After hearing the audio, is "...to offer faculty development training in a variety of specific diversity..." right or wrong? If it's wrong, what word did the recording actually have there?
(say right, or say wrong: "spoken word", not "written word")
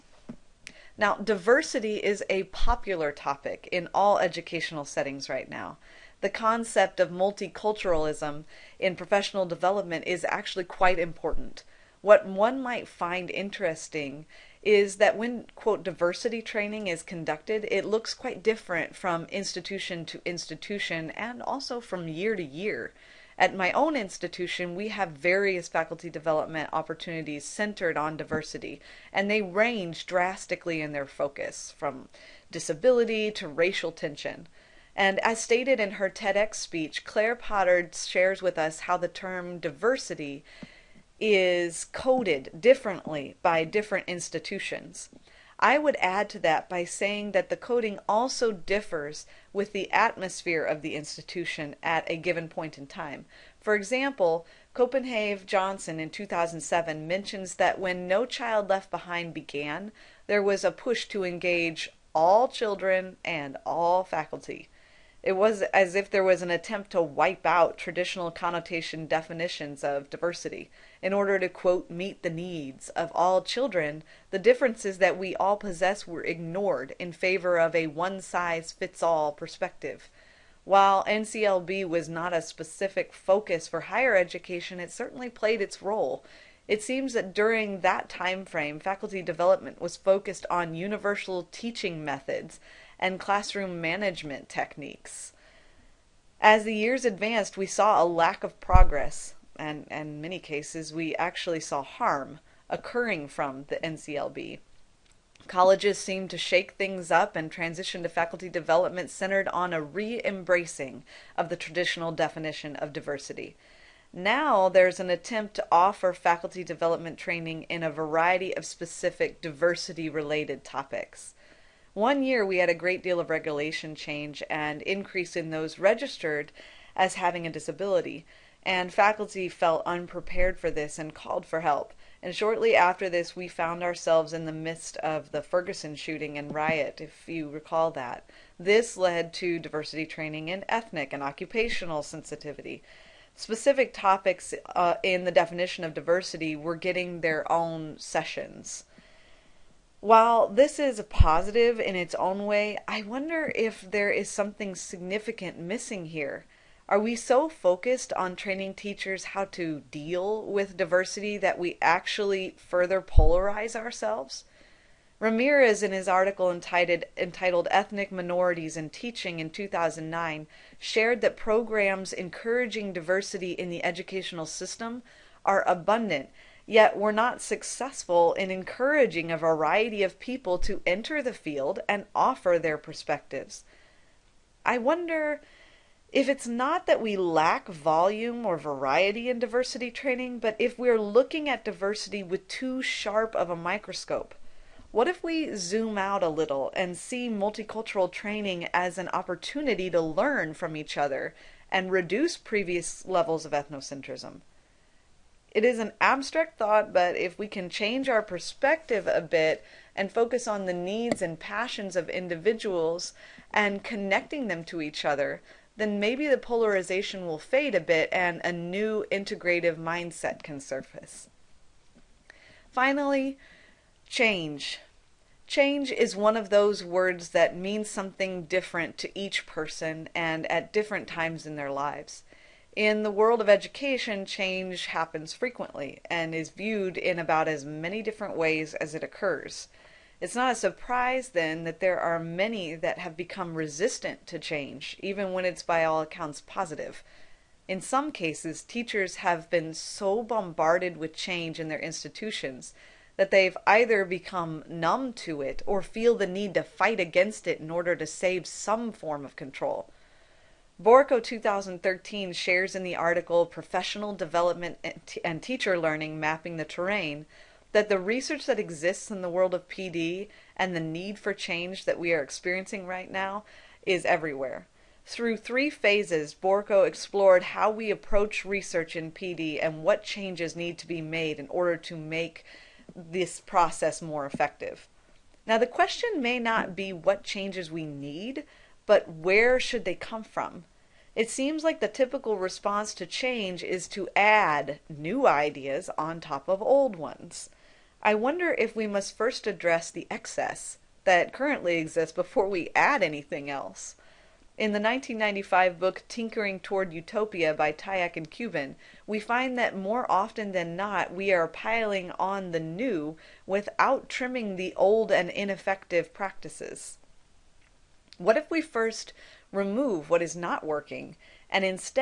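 right.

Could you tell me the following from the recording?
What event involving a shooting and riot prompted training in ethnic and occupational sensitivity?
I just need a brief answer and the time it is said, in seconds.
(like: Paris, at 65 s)
Ferguson shooting, at 135 s.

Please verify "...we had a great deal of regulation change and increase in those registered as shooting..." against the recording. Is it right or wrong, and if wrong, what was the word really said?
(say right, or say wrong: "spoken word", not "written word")
wrong: "having", not "shooting".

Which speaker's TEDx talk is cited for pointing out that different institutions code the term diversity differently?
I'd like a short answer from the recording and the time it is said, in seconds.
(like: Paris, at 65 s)
Claire Potter, at 37 s.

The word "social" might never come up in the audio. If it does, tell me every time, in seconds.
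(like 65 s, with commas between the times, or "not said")
not said.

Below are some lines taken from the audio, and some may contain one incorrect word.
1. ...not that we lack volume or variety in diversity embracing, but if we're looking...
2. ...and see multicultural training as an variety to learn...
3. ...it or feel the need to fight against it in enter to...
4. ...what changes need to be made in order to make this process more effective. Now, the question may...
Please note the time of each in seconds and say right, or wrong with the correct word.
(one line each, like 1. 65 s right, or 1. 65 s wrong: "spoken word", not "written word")
1. 186 s wrong: "training", not "embracing"
2. 196 s wrong: "opportunity", not "variety"
3. 255 s wrong: "order", not "enter"
4. 279 s right.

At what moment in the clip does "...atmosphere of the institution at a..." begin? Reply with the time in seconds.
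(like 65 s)
49 s.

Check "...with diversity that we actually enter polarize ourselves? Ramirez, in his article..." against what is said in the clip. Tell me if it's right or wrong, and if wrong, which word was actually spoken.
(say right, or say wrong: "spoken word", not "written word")
wrong: "further", not "enter".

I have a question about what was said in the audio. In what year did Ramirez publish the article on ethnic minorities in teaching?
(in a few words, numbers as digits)
2009.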